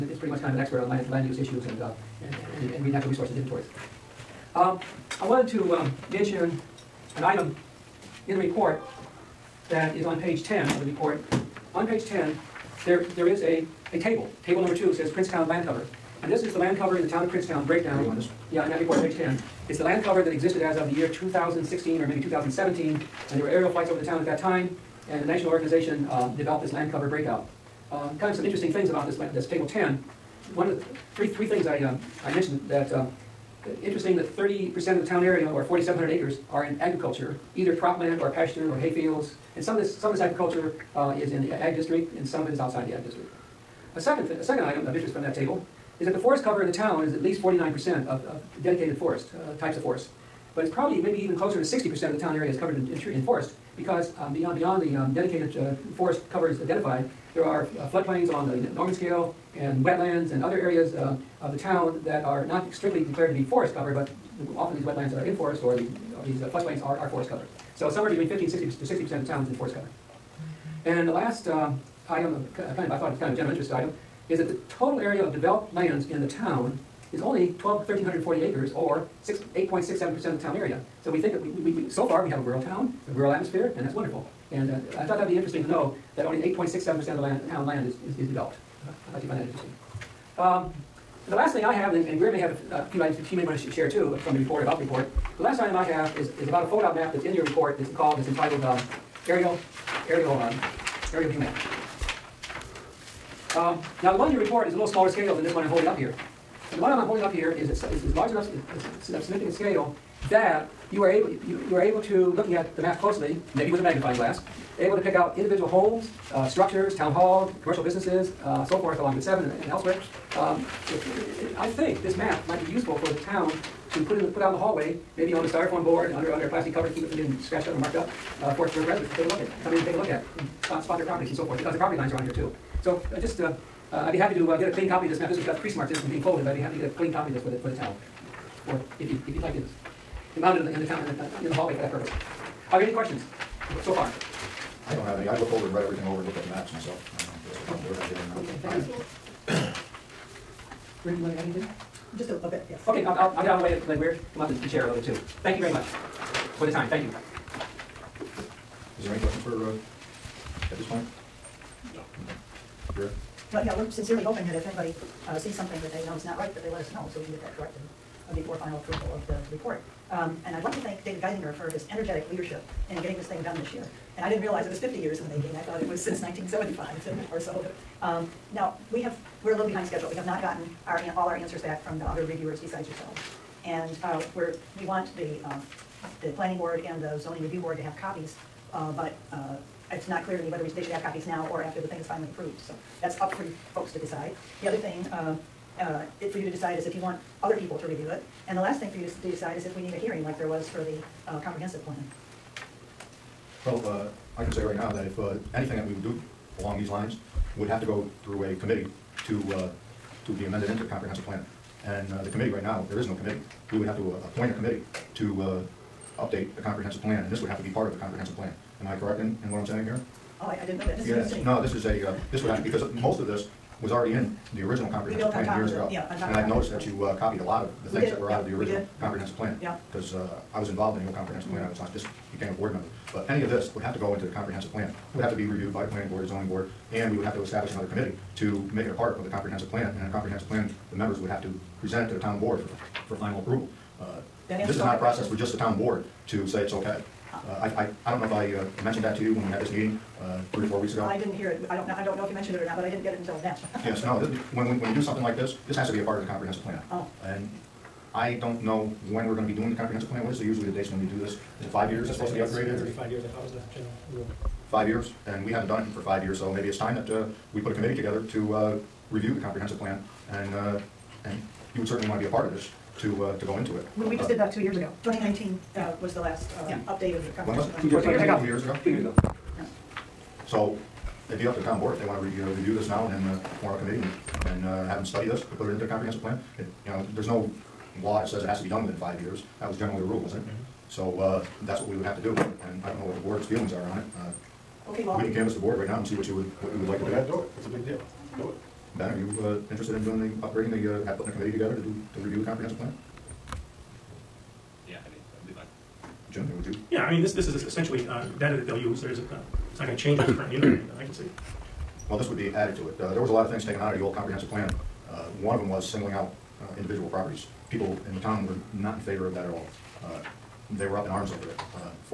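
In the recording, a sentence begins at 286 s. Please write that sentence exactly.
It- You know, there's no law that says it has to be done within five years.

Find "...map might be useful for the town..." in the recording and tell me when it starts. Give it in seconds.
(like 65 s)
122 s.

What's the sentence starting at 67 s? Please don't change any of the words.
So somewhere between 50 and 60 to 60 percent of the town is in forest cover.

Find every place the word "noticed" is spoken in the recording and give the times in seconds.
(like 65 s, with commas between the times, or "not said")
226 s.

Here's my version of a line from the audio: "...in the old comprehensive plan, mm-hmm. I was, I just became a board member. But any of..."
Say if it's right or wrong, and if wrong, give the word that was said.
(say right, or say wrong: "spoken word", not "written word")
right.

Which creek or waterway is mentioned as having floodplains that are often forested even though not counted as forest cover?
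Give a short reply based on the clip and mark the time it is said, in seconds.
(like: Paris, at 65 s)
Normans Kill, at 58 s.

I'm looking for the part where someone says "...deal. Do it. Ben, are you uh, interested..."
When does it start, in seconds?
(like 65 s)
297 s.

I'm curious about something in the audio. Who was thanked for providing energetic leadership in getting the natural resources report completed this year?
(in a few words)
David Geisinger.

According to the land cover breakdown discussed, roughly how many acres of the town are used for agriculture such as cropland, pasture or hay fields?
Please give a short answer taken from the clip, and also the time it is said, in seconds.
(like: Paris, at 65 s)
4,700 acres, at 35 s.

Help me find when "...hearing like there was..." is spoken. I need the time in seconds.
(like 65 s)
199 s.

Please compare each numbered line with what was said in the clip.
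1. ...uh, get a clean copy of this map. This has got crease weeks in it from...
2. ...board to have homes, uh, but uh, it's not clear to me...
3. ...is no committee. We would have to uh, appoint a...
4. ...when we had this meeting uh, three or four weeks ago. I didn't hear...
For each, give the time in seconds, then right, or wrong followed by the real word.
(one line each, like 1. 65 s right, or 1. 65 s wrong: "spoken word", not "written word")
1. 134 s wrong: "marks", not "weeks"
2. 187 s wrong: "copies", not "homes"
3. 212 s right
4. 249 s right.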